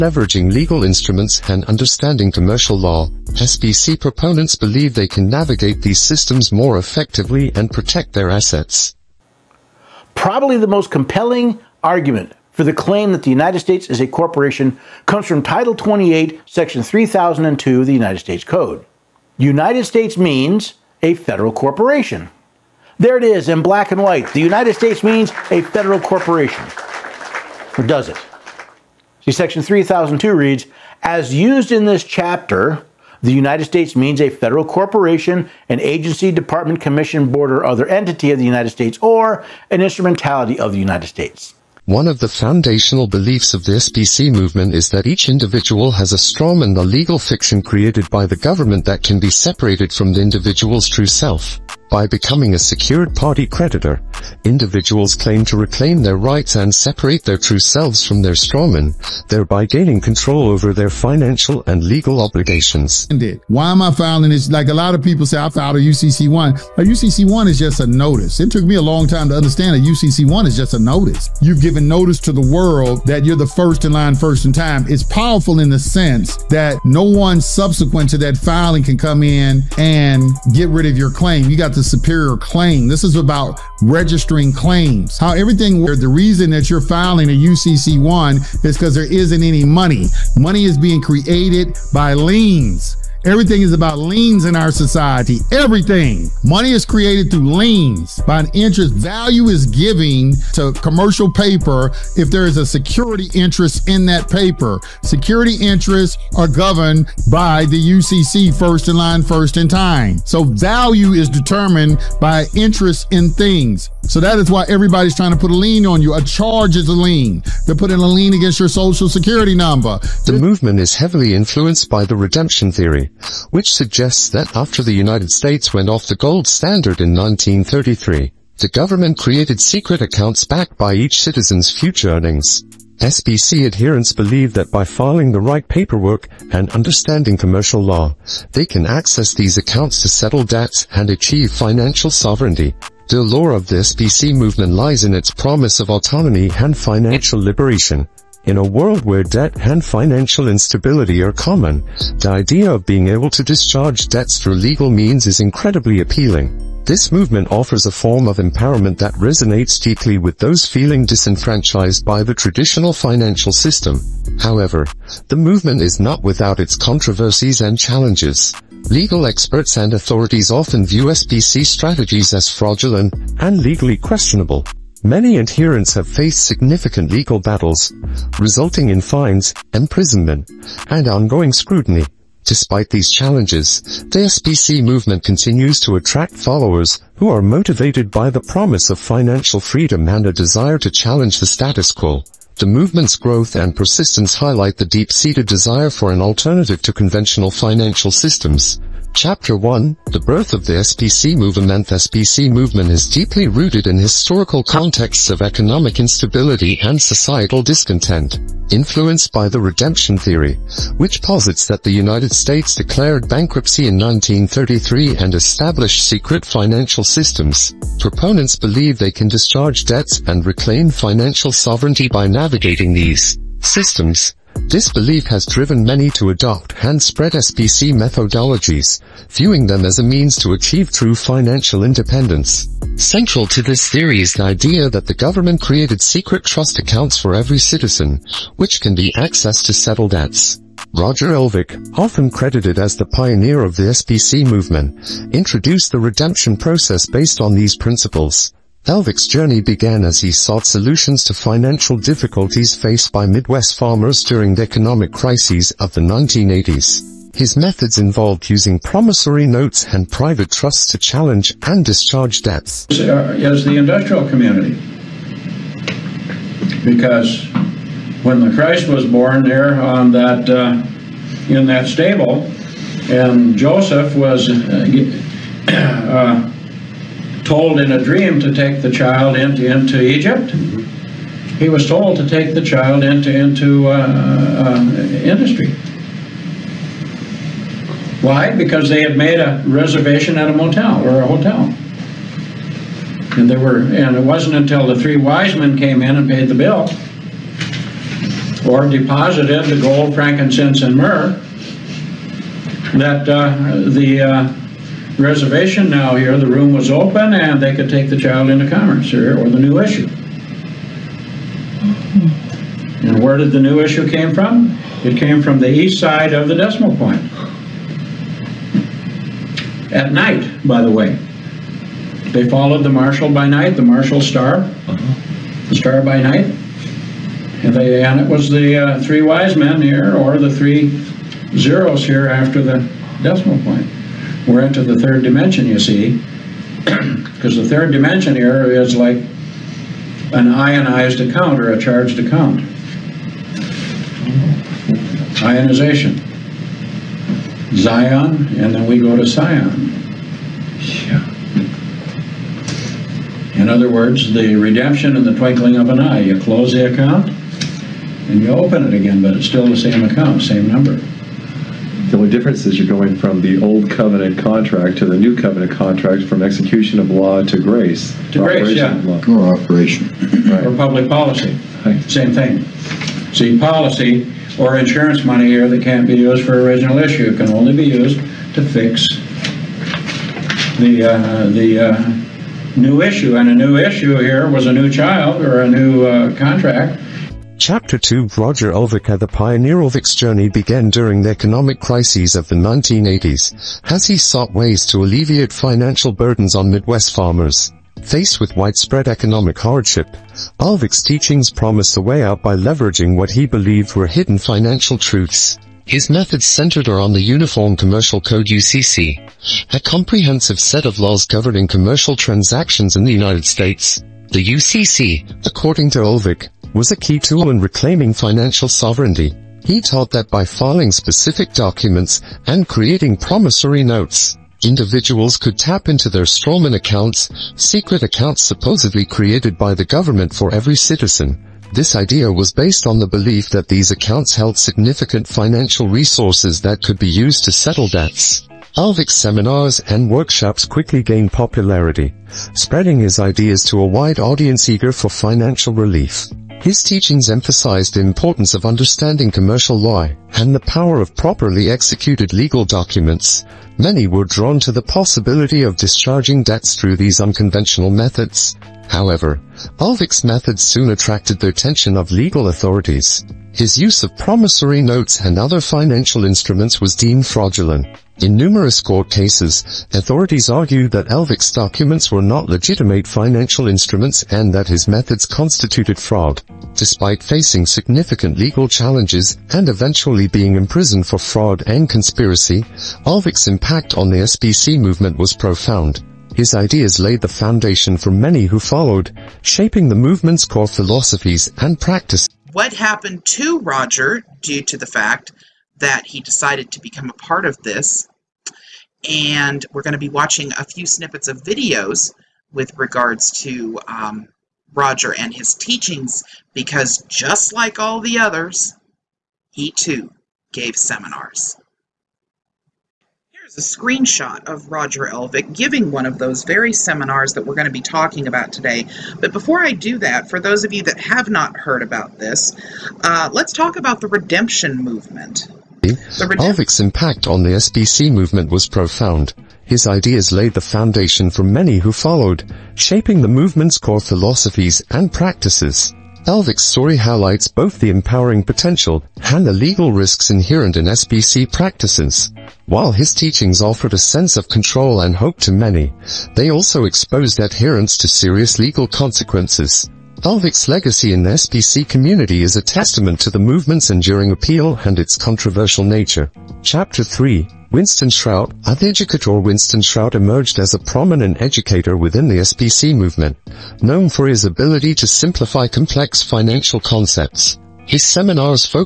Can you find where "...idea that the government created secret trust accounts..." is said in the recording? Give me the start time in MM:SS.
03:54.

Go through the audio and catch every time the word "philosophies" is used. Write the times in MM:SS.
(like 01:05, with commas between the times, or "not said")
08:10, 08:53.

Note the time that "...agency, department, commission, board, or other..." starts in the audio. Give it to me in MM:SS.
00:35.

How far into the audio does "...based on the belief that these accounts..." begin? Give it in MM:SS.
07:12.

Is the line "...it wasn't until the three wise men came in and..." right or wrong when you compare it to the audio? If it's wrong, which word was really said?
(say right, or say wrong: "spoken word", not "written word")
right.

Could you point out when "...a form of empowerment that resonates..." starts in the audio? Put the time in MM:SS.
02:37.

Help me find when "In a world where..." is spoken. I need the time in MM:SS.
02:28.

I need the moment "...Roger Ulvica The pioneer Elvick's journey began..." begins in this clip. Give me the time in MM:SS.
06:28.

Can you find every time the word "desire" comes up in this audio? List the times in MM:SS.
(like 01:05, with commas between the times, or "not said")
03:10, 03:15.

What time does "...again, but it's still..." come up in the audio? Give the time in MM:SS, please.
05:58.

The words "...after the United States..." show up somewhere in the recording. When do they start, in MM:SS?
02:04.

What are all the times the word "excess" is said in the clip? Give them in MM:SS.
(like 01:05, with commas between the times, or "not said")
not said.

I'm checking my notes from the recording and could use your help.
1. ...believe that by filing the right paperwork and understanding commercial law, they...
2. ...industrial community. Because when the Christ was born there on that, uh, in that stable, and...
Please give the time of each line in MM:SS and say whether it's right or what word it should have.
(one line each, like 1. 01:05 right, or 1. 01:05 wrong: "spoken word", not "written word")
1. 02:14 right
2. 04:23 right.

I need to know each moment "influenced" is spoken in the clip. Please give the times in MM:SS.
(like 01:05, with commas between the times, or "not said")
02:01, 03:28.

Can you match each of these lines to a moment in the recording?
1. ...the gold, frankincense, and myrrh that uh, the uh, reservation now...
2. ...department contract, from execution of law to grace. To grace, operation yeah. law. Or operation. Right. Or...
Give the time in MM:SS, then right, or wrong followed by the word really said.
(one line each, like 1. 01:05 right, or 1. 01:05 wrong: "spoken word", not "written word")
1. 04:59 right
2. 06:05 wrong: "covenant", not "department".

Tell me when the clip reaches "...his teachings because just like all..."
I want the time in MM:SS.
08:25.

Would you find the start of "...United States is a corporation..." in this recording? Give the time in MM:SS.
00:13.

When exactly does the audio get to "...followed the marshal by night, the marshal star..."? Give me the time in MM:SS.
05:22.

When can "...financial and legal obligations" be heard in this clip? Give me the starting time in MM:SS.
01:00.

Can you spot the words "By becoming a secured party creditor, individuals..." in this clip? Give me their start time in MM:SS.
00:51.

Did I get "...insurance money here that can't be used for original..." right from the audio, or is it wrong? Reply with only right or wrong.
right.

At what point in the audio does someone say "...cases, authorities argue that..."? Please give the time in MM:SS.
07:49.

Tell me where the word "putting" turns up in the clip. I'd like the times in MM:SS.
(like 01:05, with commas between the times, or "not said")
01:57.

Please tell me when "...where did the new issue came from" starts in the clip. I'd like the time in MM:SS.
05:13.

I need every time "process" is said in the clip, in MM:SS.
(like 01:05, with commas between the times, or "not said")
04:06.